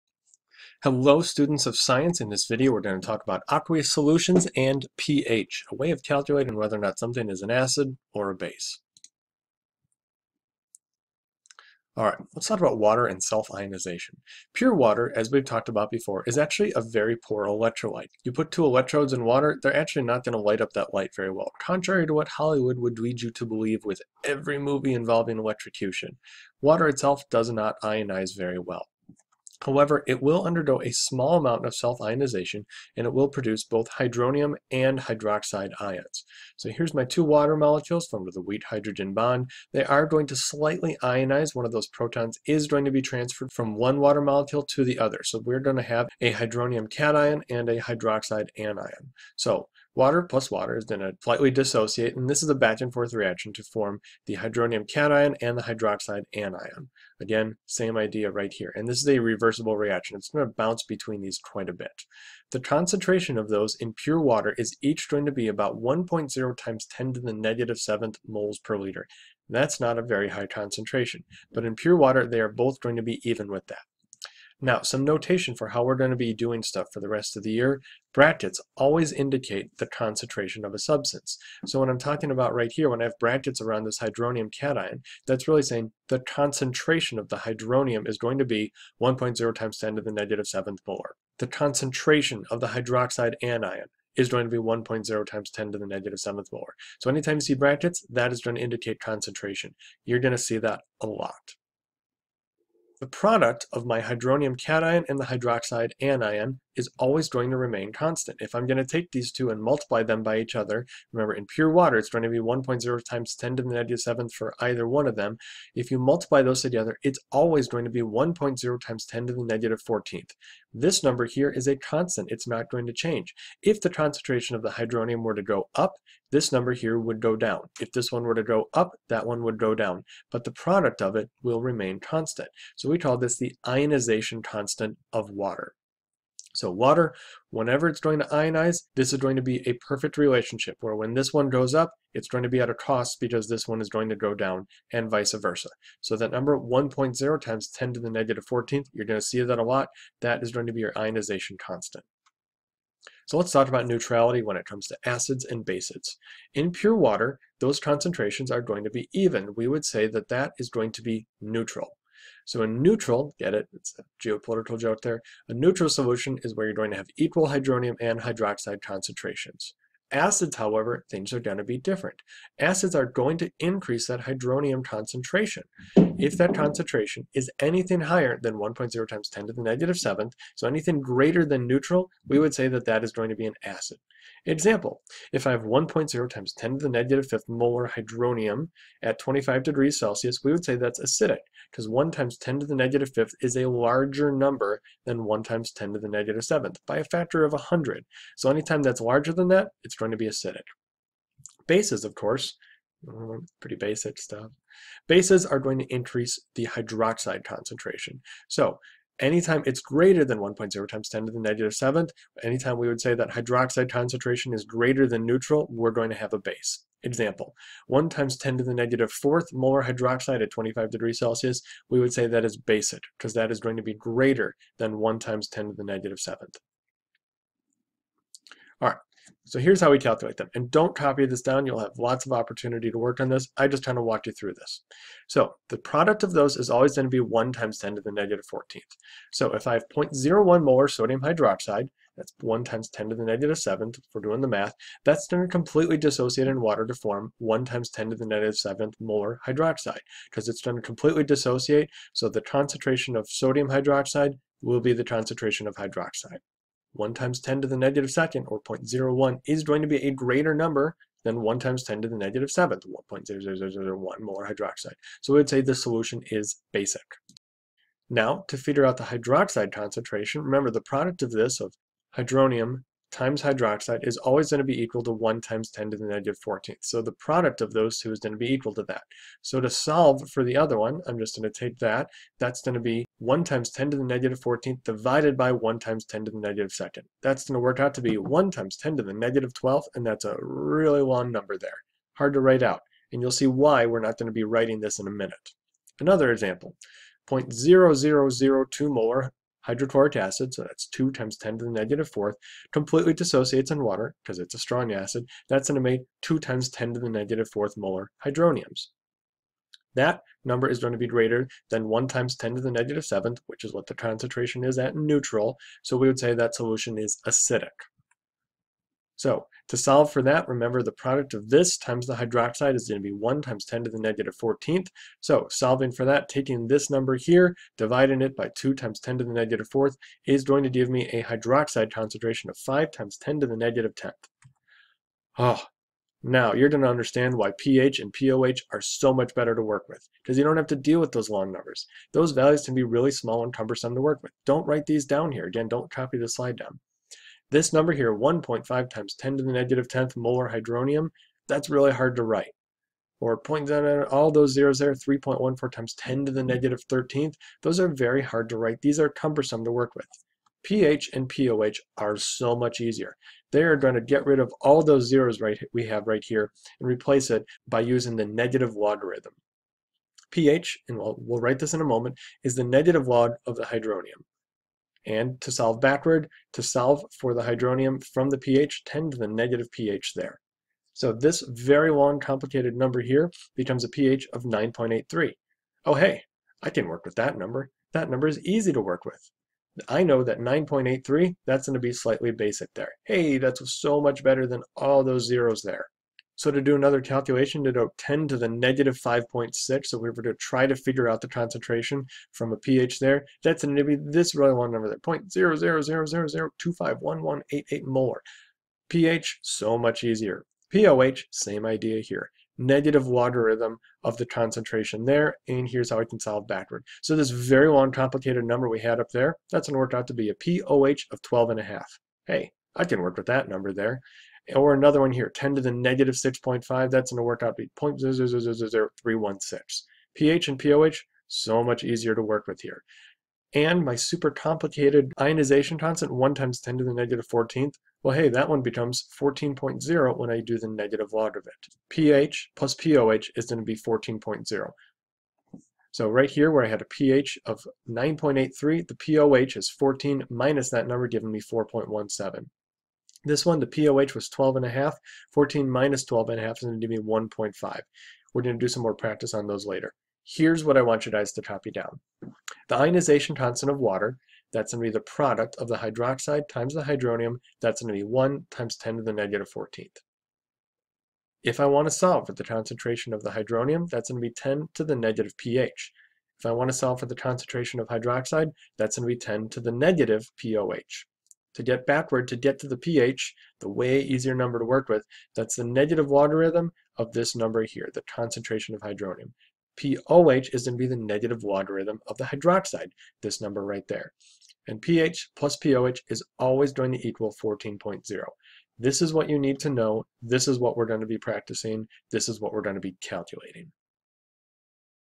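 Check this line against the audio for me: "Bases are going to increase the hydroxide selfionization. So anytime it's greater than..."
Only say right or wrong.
wrong.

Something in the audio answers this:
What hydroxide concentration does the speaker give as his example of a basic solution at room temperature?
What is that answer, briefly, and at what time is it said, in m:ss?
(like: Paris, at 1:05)
1 times 10 to the negative 4th molar, at 3:37.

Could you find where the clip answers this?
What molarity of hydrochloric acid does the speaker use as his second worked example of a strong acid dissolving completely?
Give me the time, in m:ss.
4:57.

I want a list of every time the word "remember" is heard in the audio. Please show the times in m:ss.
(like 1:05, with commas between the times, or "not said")
1:51, 4:30, 5:20.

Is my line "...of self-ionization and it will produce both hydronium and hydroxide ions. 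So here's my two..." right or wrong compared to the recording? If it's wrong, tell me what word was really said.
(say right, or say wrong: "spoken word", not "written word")
right.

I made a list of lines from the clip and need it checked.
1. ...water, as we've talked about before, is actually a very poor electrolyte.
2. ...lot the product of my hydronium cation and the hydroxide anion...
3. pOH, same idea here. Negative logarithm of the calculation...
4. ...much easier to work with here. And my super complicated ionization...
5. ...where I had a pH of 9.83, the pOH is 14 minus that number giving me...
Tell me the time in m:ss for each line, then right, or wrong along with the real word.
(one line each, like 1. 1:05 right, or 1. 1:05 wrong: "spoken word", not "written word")
1. 0:14 right
2. 1:41 right
3. 6:50 wrong: "concentration", not "calculation"
4. 7:11 right
5. 7:26 right.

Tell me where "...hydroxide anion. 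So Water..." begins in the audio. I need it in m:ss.
0:47.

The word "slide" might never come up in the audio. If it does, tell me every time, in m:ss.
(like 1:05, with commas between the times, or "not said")
5:46.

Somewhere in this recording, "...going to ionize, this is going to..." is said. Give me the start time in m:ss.
2:17.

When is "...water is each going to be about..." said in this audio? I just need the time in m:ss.
1:04.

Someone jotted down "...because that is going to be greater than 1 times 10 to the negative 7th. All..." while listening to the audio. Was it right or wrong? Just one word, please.
right.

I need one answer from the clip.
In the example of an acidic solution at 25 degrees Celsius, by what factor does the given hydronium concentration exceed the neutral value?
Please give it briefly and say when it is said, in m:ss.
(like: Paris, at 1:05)
100, at 3:16.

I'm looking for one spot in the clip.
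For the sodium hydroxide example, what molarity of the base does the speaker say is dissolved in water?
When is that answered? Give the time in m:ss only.
3:59.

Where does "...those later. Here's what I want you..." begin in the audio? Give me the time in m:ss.
7:39.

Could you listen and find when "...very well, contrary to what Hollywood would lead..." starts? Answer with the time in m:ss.
0:21.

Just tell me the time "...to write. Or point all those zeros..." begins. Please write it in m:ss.
5:52.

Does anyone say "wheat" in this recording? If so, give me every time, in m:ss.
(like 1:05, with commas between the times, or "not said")
0:38.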